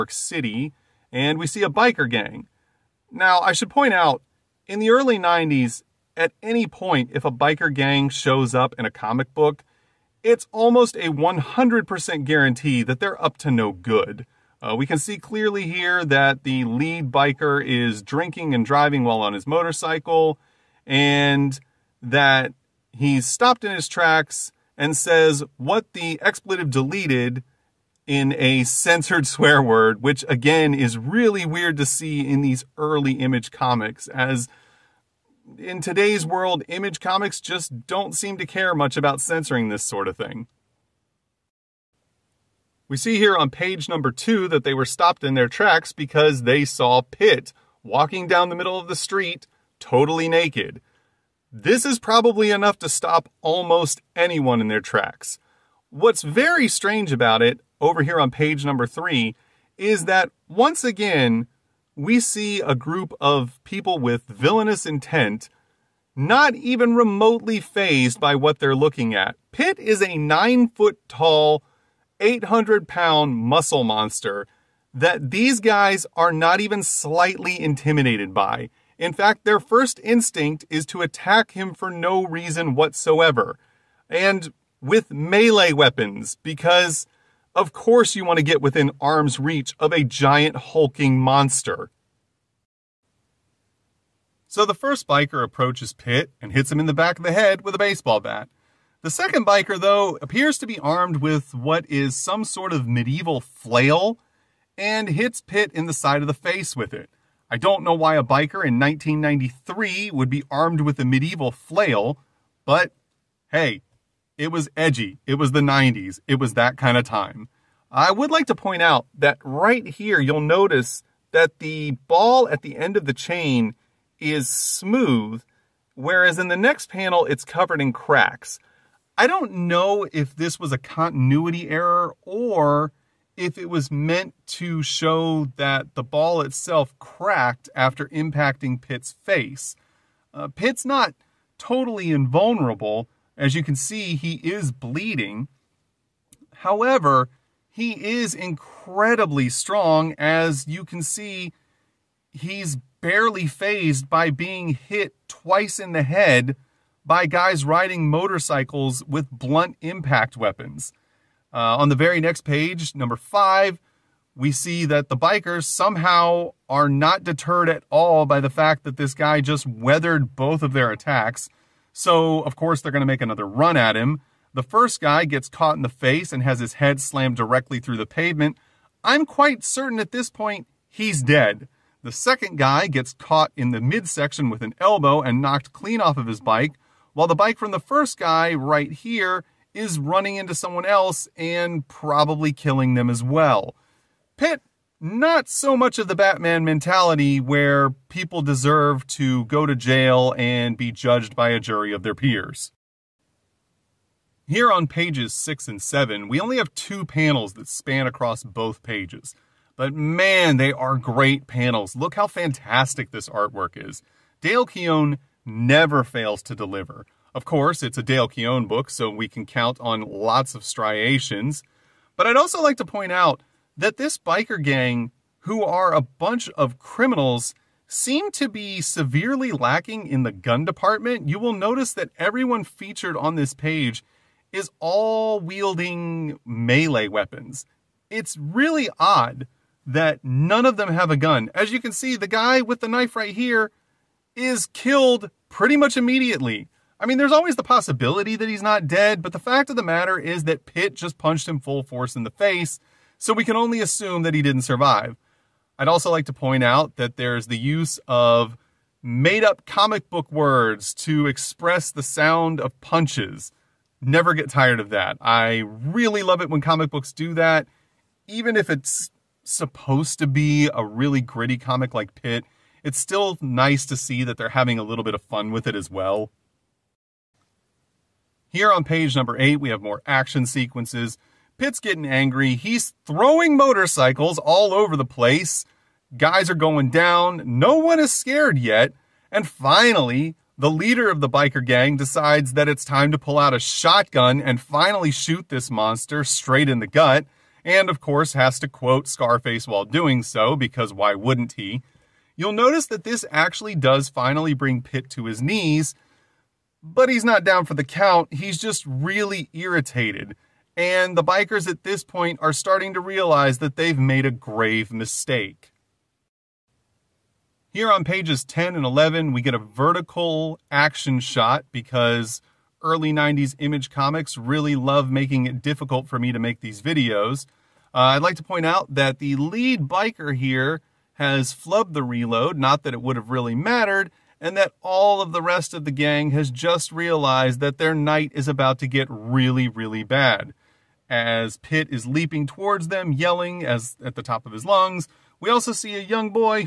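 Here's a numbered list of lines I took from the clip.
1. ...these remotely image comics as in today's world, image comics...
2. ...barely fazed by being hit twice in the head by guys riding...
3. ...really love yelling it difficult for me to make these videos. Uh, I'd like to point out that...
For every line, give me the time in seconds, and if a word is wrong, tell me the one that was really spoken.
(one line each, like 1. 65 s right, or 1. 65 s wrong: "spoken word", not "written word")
1. 32 s wrong: "early", not "remotely"
2. 152 s right
3. 324 s wrong: "making", not "yelling".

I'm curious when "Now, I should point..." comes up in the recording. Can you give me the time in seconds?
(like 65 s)
3 s.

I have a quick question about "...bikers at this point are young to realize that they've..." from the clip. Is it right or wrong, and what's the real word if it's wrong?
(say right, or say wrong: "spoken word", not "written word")
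wrong: "starting", not "young".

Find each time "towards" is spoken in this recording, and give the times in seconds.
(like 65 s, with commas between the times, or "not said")
342 s.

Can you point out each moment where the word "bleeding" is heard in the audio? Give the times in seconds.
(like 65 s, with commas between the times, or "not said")
144 s.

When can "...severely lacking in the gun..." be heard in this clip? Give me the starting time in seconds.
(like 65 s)
228 s.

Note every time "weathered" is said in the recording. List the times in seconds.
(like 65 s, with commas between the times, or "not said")
169 s.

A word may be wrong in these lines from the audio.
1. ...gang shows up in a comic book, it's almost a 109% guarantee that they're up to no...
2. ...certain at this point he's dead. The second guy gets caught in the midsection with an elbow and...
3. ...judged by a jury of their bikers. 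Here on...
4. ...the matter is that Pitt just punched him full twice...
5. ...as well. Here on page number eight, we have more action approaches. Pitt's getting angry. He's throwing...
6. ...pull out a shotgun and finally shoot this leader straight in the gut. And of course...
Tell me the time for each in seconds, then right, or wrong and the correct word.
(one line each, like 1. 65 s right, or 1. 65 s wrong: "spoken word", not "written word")
1. 7 s wrong: "100", not "109"
2. 179 s right
3. 200 s wrong: "peers", not "bikers"
4. 249 s wrong: "force", not "twice"
5. 275 s wrong: "sequences", not "approaches"
6. 293 s wrong: "monster", not "leader".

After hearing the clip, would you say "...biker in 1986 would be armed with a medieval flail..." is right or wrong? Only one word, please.
wrong.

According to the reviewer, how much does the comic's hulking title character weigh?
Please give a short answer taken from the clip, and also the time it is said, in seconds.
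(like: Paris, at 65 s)
800 pounds, at 72 s.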